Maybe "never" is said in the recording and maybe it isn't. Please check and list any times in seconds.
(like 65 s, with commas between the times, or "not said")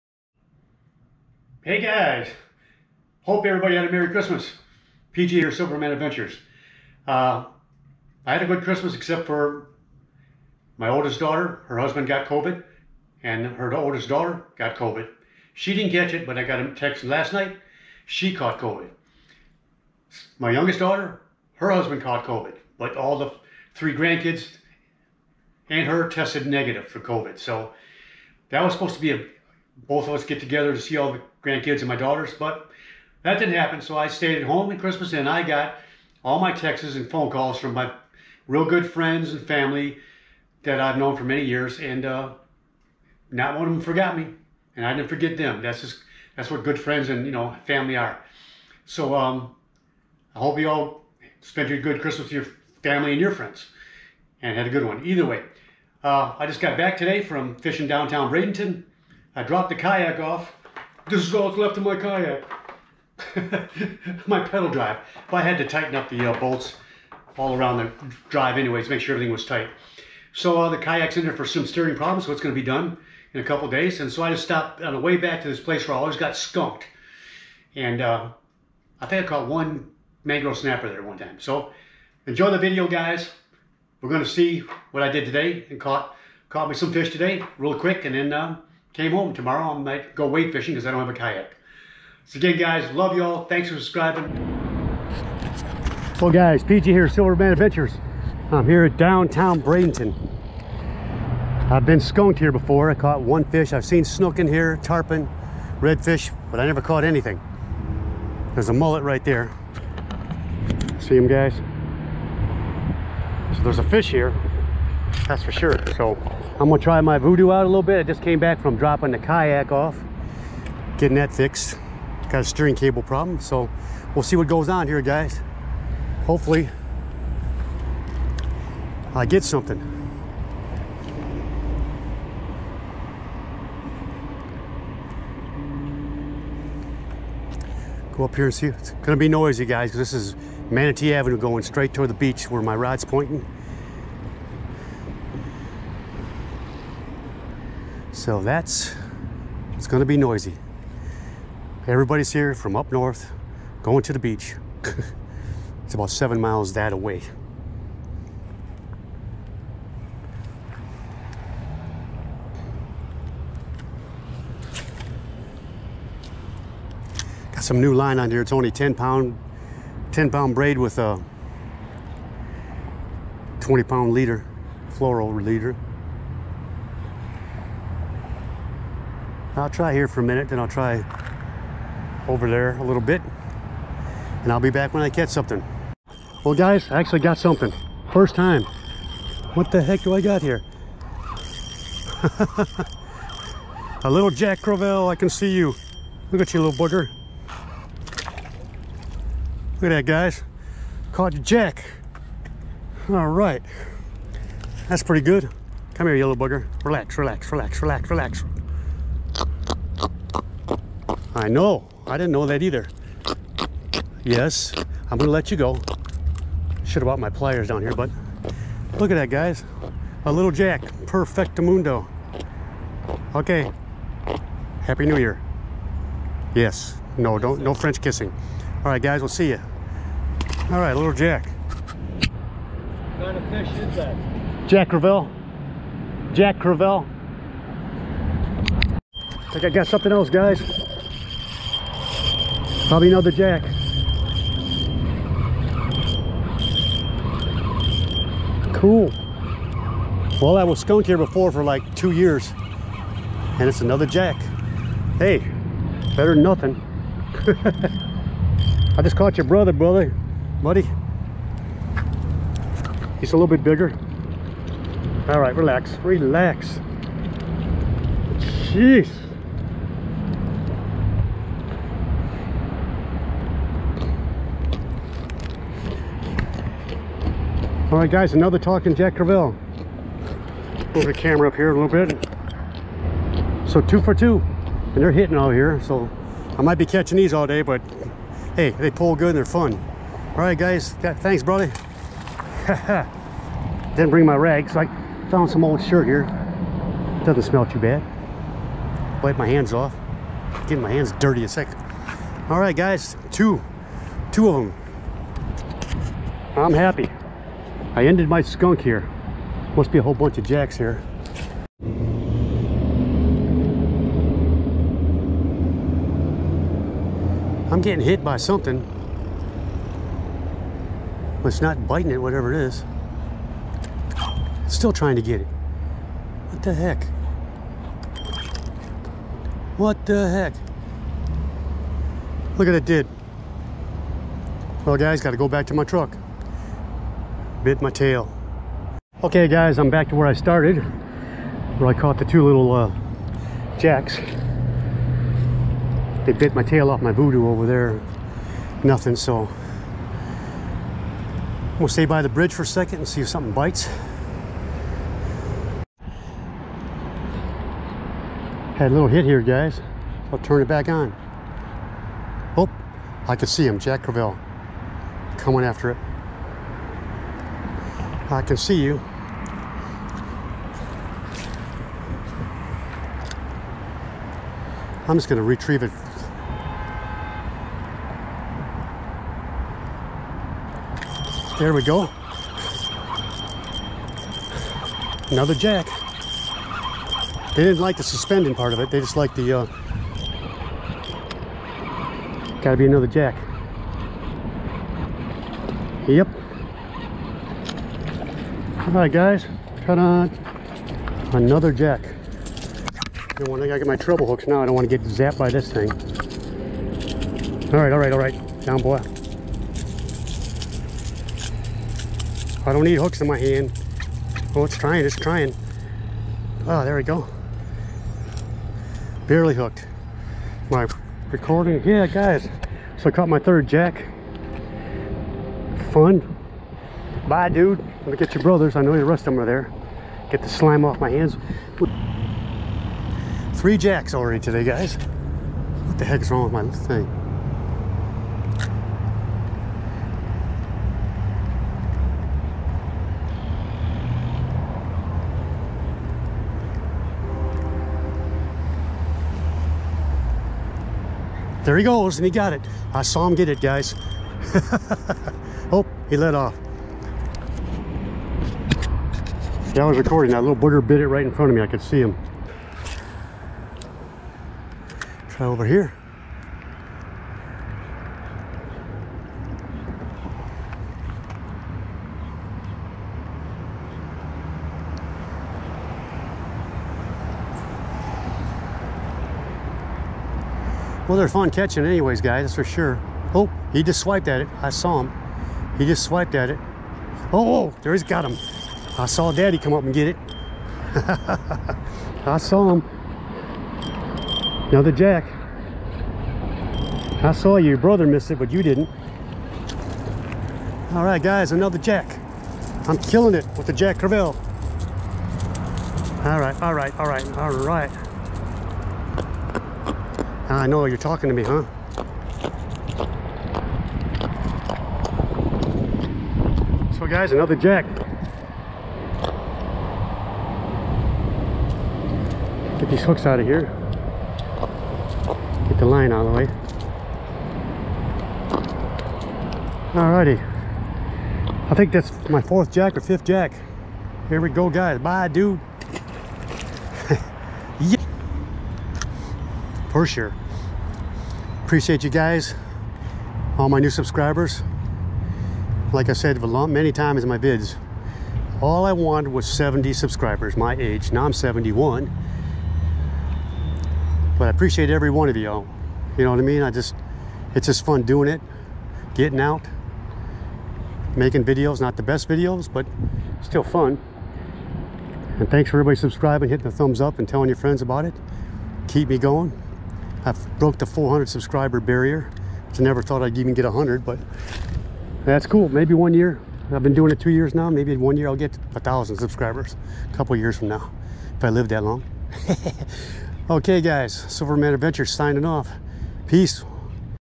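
106 s, 572 s.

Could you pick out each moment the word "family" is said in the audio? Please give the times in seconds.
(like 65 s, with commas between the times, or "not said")
39 s, 47 s, 52 s.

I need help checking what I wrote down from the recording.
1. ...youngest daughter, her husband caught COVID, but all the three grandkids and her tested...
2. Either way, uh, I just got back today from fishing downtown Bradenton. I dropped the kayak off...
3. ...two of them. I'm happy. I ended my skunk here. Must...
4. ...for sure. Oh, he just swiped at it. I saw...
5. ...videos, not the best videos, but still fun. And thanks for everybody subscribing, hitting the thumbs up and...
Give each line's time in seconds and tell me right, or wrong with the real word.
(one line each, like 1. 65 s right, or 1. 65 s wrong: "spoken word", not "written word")
1. 20 s right
2. 55 s right
3. 304 s right
4. 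482 s right
5. 561 s right.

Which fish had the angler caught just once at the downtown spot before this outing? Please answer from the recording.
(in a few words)
mangrove snapper.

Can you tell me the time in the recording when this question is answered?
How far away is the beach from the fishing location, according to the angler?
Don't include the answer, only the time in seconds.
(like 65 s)
155 s.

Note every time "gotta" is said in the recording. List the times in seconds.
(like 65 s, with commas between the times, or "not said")
335 s, 392 s.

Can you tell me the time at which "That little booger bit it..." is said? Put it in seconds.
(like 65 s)
460 s.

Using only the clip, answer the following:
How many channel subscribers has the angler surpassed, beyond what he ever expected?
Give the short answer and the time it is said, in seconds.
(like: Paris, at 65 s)
400, at 570 s.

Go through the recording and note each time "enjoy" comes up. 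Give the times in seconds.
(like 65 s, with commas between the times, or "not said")
82 s.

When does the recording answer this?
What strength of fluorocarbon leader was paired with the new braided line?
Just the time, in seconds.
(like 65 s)
173 s.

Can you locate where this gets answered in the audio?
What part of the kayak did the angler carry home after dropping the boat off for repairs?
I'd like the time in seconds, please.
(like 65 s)
64 s.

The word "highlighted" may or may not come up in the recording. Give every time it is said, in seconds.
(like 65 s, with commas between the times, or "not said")
not said.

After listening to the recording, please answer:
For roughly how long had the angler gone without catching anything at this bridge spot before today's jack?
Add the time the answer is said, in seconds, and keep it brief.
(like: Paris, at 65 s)
2 years, at 251 s.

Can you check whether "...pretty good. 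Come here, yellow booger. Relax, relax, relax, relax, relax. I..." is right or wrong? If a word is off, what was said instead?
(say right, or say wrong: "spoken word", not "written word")
right.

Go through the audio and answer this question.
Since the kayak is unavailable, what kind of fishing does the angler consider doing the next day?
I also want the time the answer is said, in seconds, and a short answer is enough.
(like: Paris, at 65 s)
wade fishing, at 90 s.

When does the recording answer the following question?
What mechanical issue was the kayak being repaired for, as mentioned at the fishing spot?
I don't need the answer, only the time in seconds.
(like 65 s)
122 s.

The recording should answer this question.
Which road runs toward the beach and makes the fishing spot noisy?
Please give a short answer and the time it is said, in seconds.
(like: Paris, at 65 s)
Manatee Avenue, at 140 s.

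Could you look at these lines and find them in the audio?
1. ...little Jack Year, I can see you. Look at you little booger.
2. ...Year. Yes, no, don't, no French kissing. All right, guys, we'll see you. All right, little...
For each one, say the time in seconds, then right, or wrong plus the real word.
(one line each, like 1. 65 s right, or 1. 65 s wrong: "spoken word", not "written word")
1. 194 s wrong: "Crevalle", not "Year"
2. 225 s right.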